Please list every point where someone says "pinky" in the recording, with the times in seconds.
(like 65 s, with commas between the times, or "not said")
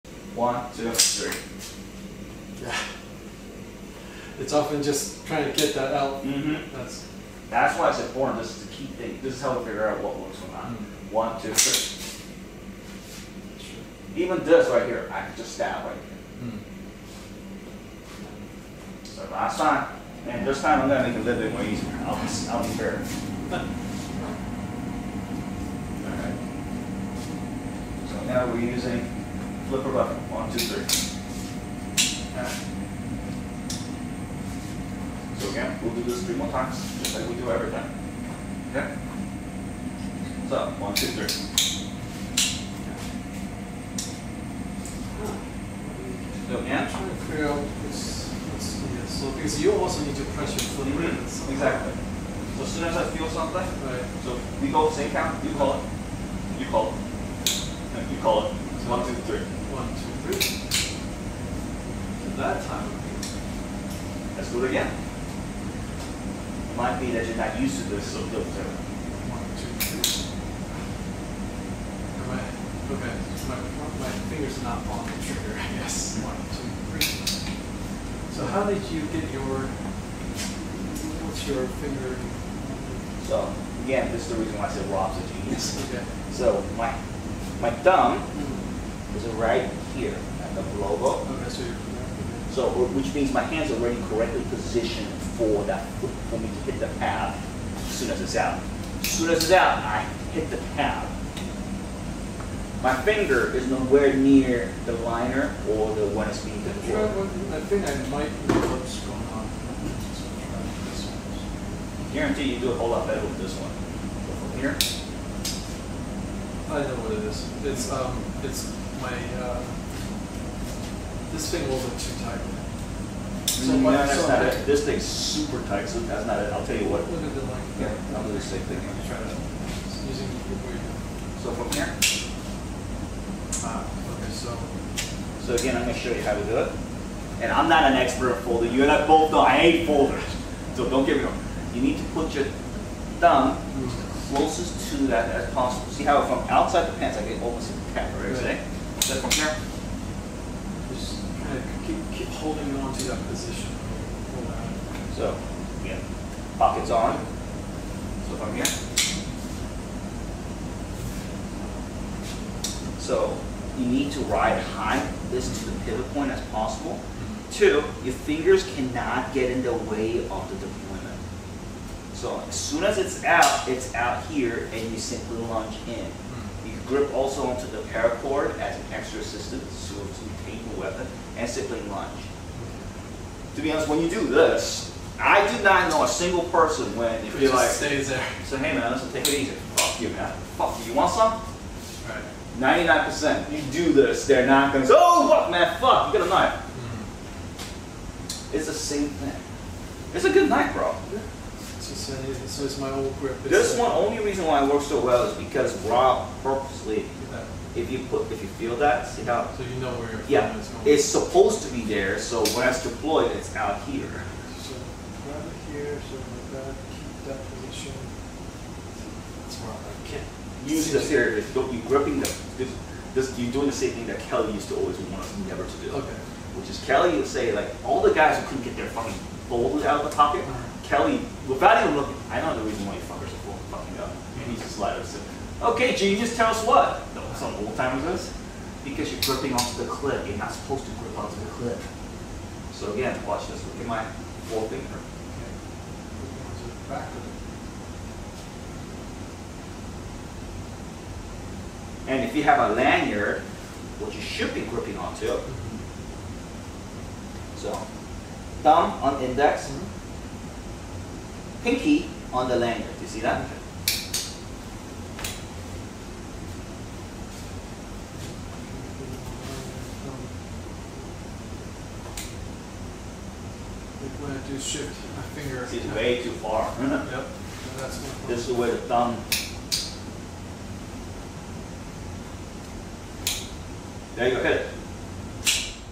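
261 s.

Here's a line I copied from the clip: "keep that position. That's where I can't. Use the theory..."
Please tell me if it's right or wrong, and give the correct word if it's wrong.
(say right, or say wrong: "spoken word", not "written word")
right.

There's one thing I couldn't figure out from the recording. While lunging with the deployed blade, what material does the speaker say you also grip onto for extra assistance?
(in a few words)
paracord.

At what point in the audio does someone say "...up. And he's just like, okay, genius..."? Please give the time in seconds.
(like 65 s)
233 s.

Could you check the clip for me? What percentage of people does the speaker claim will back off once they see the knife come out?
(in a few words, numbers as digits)
99%.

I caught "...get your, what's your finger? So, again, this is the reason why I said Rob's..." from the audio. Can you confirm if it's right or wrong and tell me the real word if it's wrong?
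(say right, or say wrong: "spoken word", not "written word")
right.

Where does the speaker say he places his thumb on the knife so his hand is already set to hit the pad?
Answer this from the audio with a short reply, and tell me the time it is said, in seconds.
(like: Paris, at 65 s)
at the logo, at 90 s.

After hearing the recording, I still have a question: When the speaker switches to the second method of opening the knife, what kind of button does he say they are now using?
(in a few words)
flipper button.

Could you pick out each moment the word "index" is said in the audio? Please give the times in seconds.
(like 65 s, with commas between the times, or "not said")
259 s.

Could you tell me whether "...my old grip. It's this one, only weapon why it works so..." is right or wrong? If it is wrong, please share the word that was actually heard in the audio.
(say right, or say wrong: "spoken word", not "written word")
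wrong: "reason", not "weapon".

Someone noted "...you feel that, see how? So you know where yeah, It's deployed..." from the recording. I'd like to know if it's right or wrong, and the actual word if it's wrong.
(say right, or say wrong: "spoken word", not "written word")
wrong: "supposed", not "deployed".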